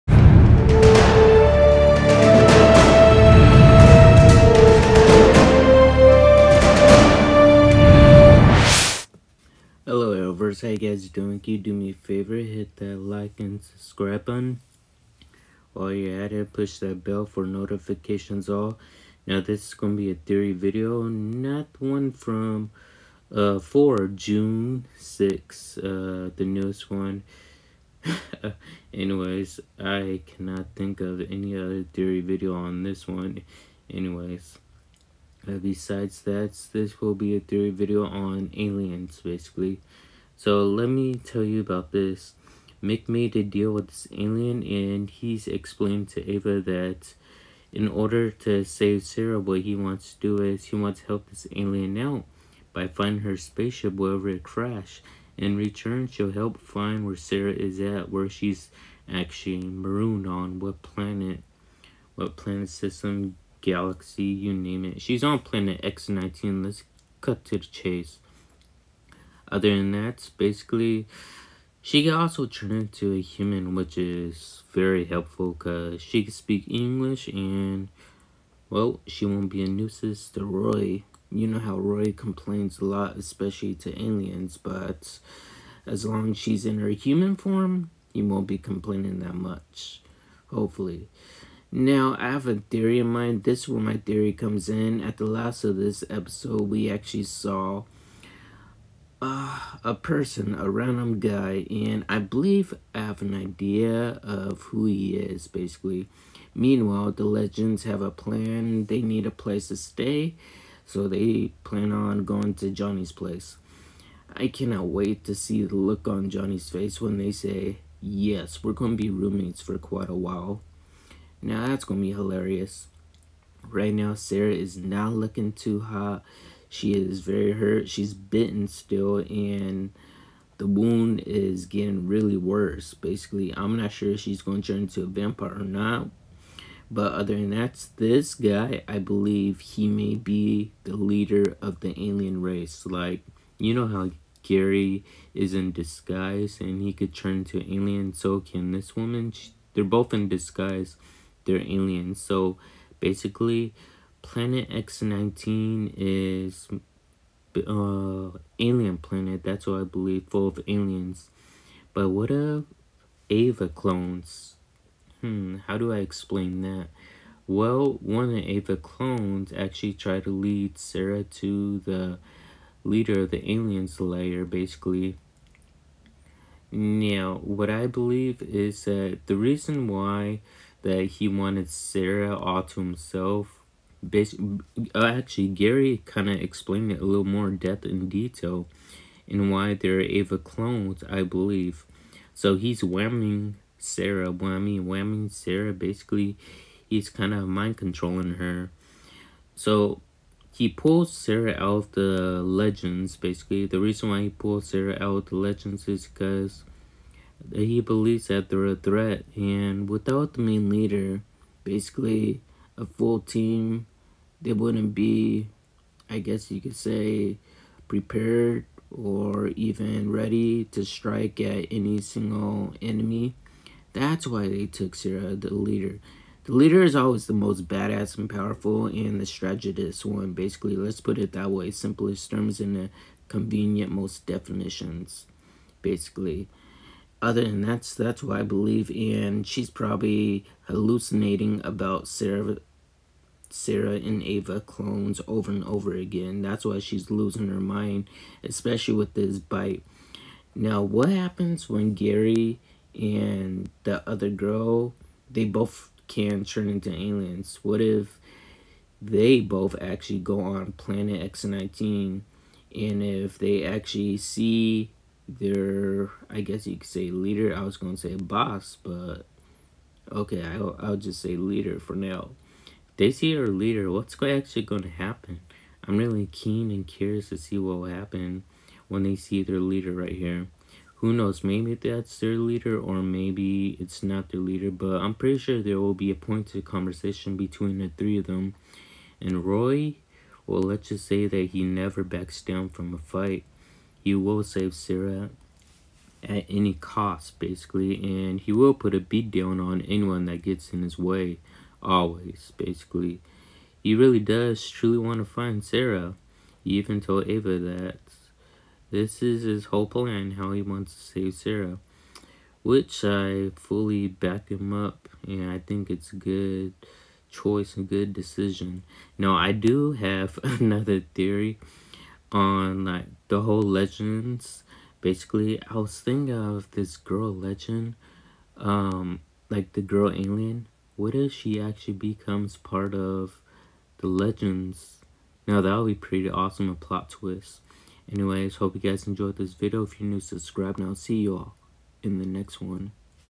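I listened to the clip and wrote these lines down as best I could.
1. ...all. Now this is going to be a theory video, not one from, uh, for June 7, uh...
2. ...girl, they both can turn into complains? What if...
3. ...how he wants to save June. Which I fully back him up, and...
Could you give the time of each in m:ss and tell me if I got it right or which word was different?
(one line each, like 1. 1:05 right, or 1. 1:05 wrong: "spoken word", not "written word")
1. 0:18 wrong: "6", not "7"
2. 4:14 wrong: "aliens", not "complains"
3. 5:10 wrong: "Sara", not "June".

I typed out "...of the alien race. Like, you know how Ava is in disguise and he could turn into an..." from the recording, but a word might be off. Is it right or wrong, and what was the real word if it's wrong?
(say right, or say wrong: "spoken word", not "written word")
wrong: "Gary", not "Ava".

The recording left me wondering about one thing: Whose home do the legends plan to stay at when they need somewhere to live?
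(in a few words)
Johnny's place.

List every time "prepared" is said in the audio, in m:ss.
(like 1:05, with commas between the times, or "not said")
3:37.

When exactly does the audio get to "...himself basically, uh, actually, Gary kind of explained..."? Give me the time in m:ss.
3:02.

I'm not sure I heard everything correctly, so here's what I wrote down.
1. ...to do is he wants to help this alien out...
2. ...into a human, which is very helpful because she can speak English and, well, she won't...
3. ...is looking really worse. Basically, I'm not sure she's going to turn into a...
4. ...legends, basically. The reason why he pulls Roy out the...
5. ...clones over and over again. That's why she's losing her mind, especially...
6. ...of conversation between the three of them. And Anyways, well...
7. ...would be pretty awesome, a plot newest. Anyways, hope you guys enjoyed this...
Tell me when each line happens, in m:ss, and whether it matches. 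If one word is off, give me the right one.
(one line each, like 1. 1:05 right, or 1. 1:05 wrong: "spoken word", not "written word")
1. 0:50 right
2. 1:12 right
3. 2:11 wrong: "getting", not "looking"
4. 3:22 wrong: "Sara", not "Roy"
5. 4:04 right
6. 4:46 wrong: "Roy", not "Anyways"
7. 5:35 wrong: "twist", not "newest".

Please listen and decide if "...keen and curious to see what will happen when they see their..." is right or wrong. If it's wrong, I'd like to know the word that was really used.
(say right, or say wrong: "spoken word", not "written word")
right.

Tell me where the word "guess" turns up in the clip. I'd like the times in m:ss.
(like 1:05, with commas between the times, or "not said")
3:36, 4:26.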